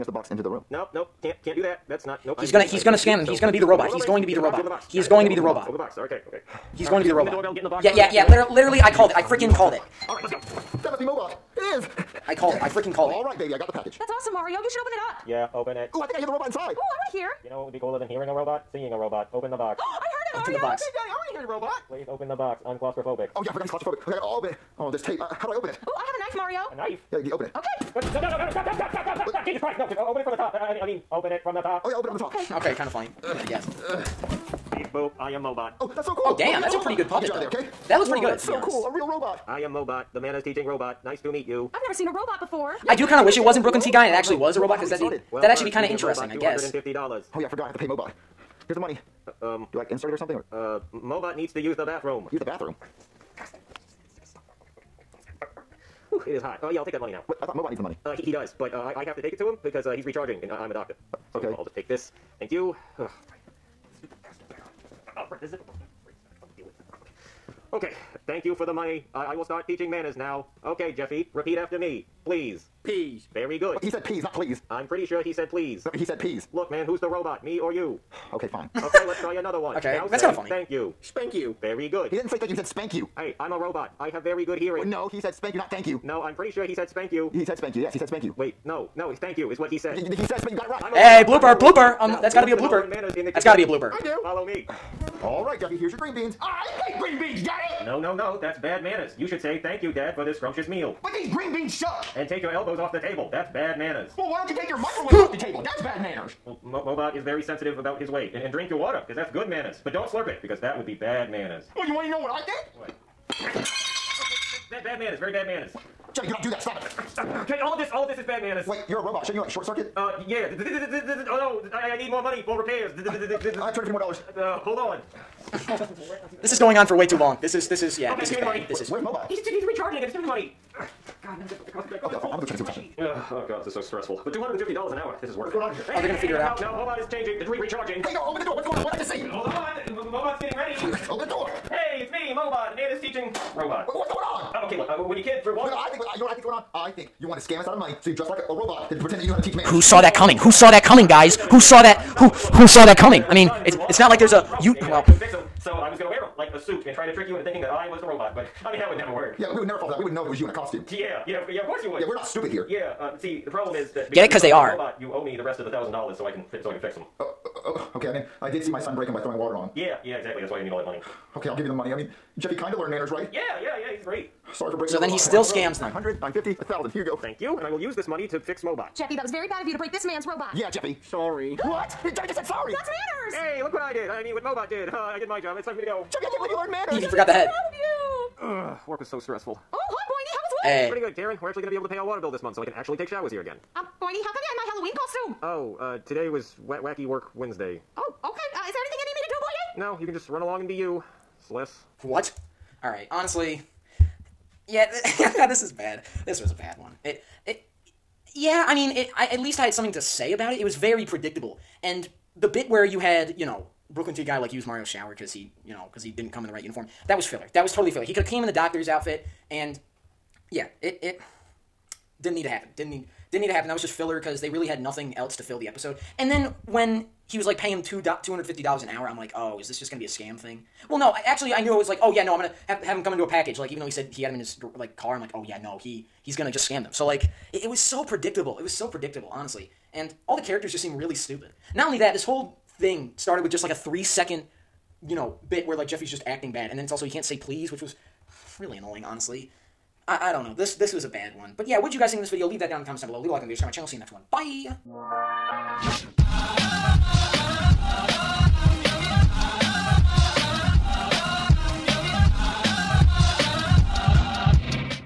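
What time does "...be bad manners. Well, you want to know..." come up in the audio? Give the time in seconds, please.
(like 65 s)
110 s.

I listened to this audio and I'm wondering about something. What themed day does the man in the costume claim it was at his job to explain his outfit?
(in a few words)
wet, wacky work Wednesday.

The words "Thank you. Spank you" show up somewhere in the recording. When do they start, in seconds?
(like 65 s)
80 s.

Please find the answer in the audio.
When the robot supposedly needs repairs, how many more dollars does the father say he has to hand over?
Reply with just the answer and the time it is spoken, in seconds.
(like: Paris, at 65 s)
250, at 122 s.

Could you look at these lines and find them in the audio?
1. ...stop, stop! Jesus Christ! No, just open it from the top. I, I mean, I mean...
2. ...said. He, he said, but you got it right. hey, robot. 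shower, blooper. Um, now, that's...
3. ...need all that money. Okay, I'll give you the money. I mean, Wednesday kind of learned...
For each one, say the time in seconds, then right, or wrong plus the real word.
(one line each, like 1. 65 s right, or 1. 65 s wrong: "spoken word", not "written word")
1. 29 s right
2. 89 s wrong: "blooper", not "shower"
3. 170 s wrong: "Jeffy", not "Wednesday".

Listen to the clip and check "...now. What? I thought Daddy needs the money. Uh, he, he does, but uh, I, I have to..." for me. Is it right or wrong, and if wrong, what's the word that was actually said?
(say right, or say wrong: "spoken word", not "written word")
wrong: "Mobot", not "Daddy".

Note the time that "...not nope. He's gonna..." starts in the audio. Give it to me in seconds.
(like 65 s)
2 s.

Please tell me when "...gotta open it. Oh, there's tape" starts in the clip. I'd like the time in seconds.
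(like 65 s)
24 s.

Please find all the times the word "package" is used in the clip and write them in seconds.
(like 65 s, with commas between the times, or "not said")
13 s, 233 s.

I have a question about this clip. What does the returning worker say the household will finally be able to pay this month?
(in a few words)
water bill.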